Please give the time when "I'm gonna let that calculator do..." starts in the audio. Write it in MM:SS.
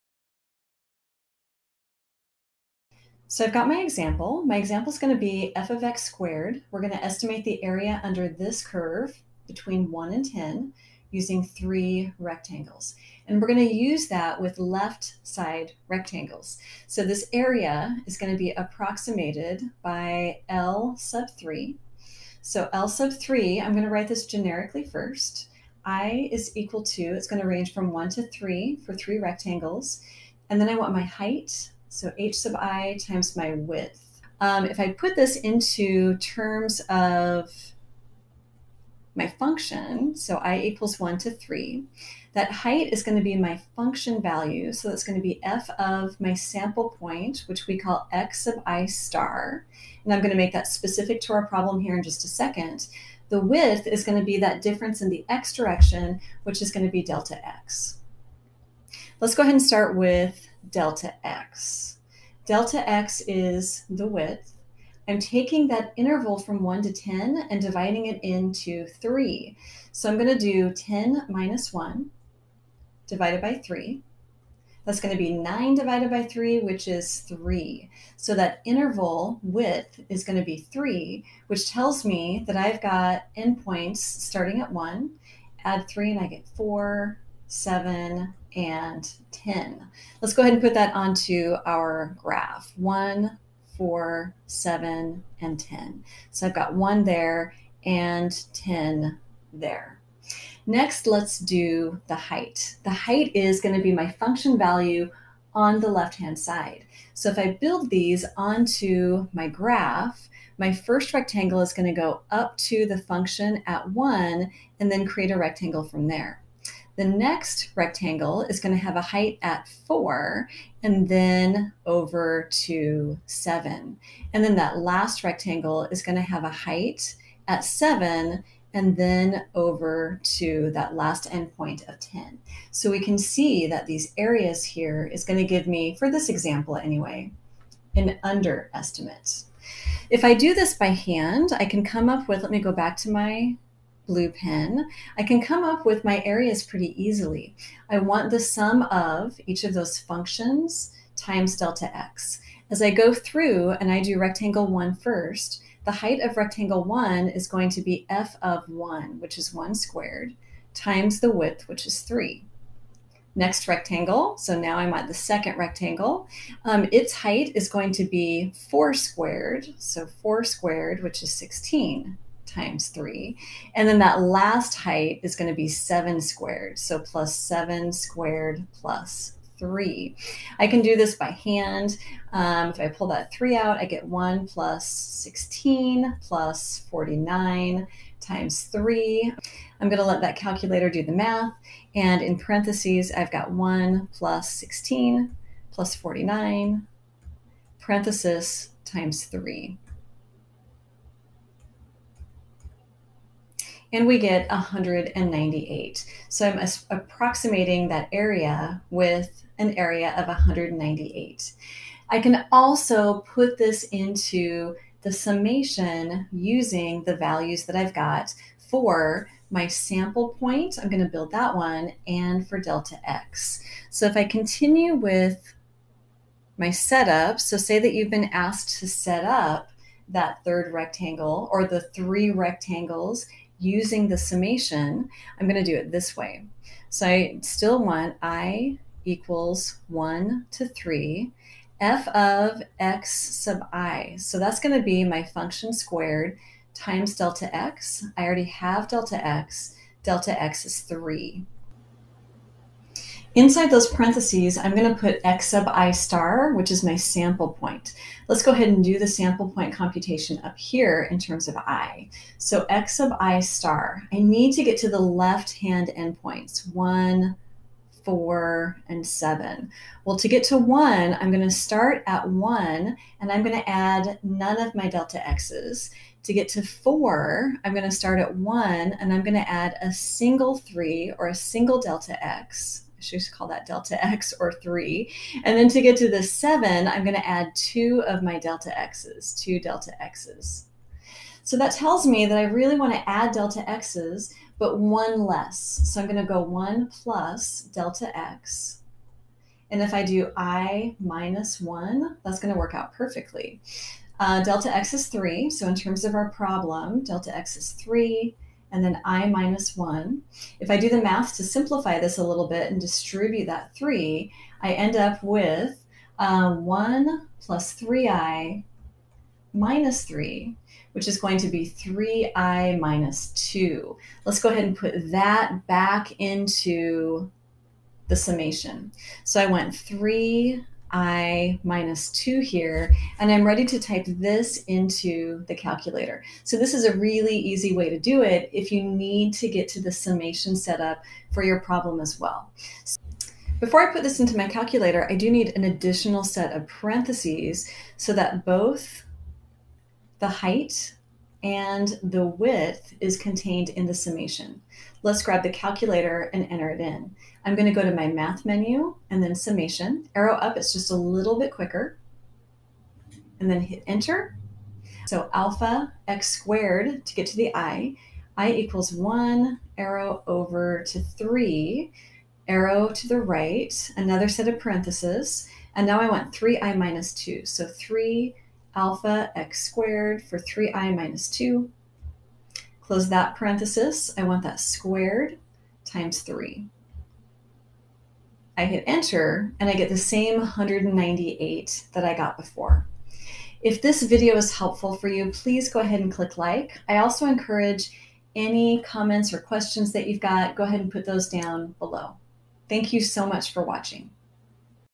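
03:09.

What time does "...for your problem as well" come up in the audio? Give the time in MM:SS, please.
05:41.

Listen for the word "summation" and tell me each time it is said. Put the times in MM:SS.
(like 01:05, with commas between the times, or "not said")
03:35, 03:54, 05:28, 05:39, 05:53, 05:59.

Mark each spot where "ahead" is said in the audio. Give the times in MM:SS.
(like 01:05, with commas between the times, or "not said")
00:59, 01:30, 04:18, 05:24, 06:35, 06:40.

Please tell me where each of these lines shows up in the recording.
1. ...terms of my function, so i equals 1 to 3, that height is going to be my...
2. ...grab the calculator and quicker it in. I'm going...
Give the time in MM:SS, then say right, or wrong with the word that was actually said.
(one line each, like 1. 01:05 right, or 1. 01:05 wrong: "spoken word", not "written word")
1. 00:36 right
2. 05:55 wrong: "enter", not "quicker".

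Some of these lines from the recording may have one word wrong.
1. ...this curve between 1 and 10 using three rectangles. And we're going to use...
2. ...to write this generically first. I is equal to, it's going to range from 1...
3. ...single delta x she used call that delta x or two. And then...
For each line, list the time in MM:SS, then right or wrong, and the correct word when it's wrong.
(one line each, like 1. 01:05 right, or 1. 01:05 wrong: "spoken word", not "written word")
1. 00:08 right
2. 00:23 right
3. 04:41 wrong: "three", not "two".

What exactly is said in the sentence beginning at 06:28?
I hit enter and I get the same 198 that I got before.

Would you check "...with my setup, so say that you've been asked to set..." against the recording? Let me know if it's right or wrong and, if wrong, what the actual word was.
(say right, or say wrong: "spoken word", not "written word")
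right.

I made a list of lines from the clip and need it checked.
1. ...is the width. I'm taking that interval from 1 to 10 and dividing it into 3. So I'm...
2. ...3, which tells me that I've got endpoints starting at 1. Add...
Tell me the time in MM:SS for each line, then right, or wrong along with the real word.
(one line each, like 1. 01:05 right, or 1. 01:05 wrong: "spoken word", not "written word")
1. 01:03 right
2. 01:20 right.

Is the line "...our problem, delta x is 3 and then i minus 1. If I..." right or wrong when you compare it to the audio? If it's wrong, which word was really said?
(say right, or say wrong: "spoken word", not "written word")
right.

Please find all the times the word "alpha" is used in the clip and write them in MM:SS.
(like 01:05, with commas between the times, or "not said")
06:05, 06:18.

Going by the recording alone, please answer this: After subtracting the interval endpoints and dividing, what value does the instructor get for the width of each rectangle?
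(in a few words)
3.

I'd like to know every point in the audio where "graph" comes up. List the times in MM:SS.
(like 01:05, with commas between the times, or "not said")
01:32, 01:49.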